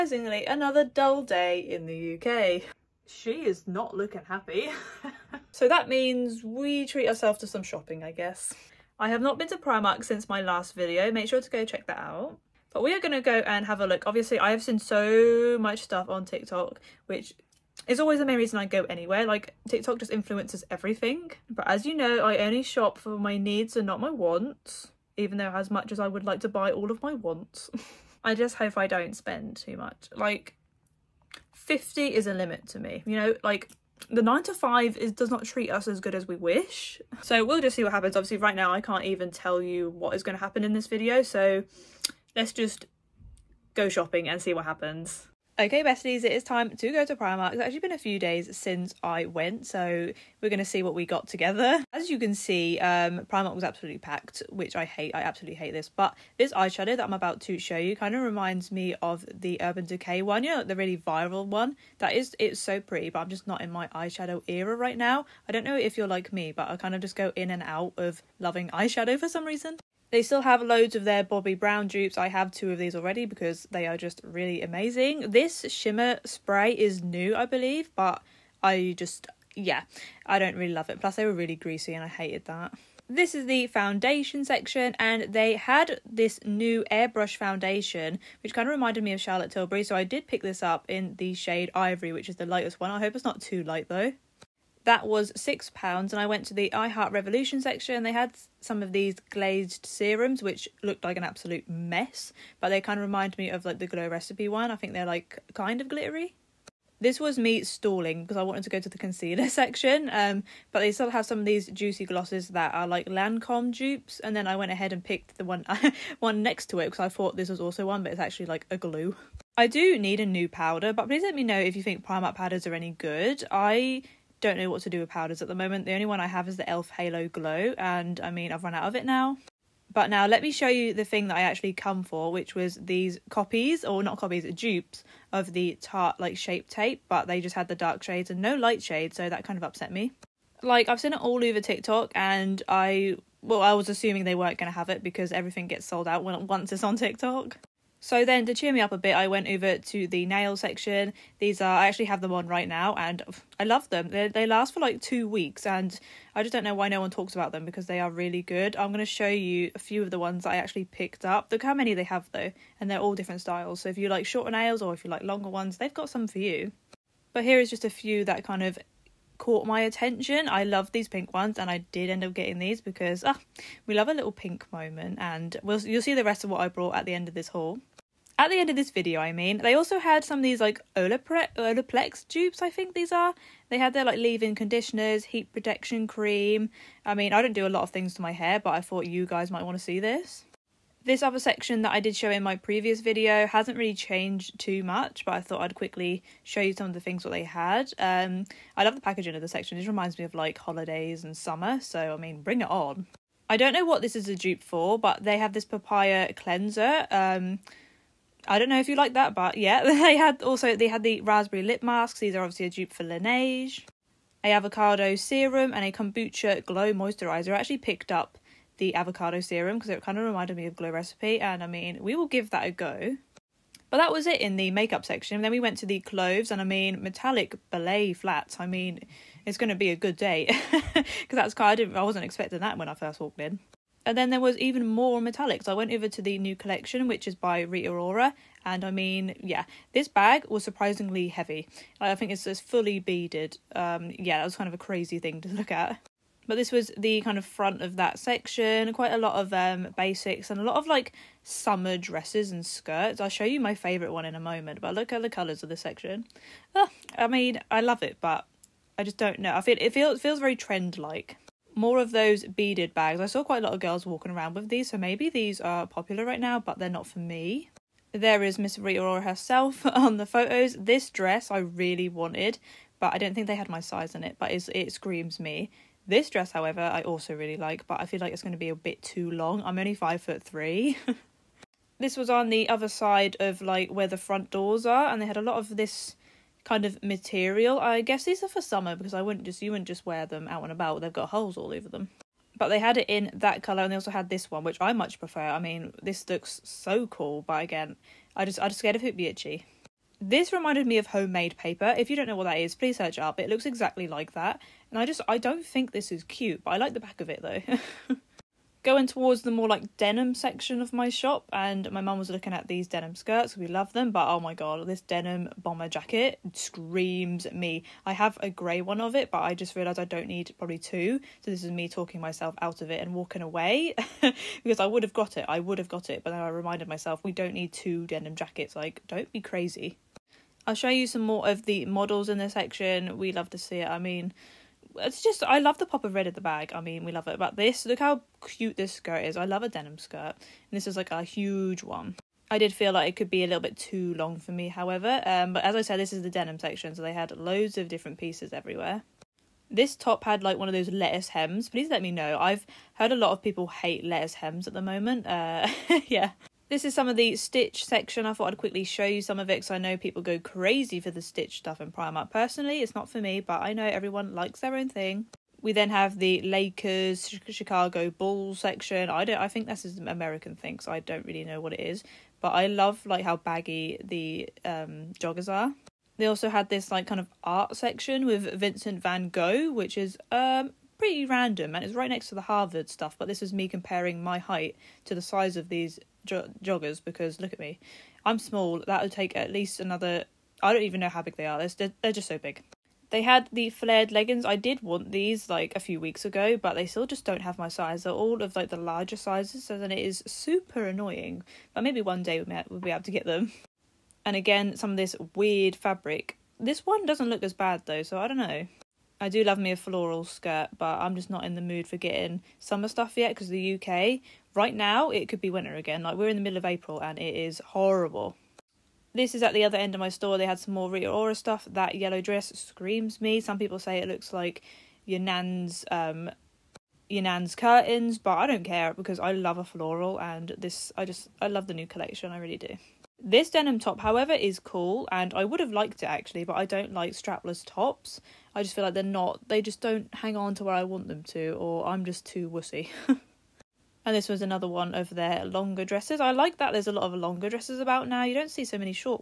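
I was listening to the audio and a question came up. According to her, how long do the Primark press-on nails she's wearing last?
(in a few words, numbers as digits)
2 weeks.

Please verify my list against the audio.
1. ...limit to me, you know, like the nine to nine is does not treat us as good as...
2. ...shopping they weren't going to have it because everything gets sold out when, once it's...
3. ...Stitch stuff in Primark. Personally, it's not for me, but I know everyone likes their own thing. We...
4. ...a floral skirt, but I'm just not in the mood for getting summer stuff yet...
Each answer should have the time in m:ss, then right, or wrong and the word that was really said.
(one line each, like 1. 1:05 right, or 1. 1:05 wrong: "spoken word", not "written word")
1. 0:32 wrong: "five", not "nine"
2. 2:23 wrong: "assuming", not "shopping"
3. 6:01 right
4. 6:49 right.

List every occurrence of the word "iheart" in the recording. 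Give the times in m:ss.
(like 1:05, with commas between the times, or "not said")
1:36.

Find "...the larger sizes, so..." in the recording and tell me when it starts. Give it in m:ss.
6:38.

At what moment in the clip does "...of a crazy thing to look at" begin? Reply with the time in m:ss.
4:04.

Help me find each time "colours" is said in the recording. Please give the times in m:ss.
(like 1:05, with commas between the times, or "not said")
4:15, 4:53.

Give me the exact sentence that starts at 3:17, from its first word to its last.
Um, I love the packaging of the section.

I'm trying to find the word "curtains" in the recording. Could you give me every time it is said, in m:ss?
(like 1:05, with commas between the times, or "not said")
7:07.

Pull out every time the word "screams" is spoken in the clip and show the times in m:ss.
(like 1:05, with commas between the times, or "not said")
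4:34, 5:16, 7:02.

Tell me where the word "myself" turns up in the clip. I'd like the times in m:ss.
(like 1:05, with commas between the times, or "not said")
5:22, 5:26.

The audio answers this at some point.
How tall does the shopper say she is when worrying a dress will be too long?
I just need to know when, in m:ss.
4:39.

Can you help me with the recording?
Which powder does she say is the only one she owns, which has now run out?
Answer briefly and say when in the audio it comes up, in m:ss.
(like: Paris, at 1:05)
e.l.f. Halo Glow, at 2:06.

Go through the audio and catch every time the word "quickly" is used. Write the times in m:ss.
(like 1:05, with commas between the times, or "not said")
3:15, 5:58.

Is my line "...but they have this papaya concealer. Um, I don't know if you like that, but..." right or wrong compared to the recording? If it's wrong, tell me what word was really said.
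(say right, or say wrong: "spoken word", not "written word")
wrong: "cleanser", not "concealer".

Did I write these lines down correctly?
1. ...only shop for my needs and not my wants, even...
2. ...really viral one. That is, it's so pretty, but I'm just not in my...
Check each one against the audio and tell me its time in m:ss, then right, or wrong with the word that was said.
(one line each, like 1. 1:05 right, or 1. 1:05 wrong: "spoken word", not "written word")
1. 0:22 right
2. 1:00 right.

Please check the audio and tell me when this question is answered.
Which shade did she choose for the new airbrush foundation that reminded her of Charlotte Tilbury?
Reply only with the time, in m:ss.
1:31.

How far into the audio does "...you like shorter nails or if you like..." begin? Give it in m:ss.
2:43.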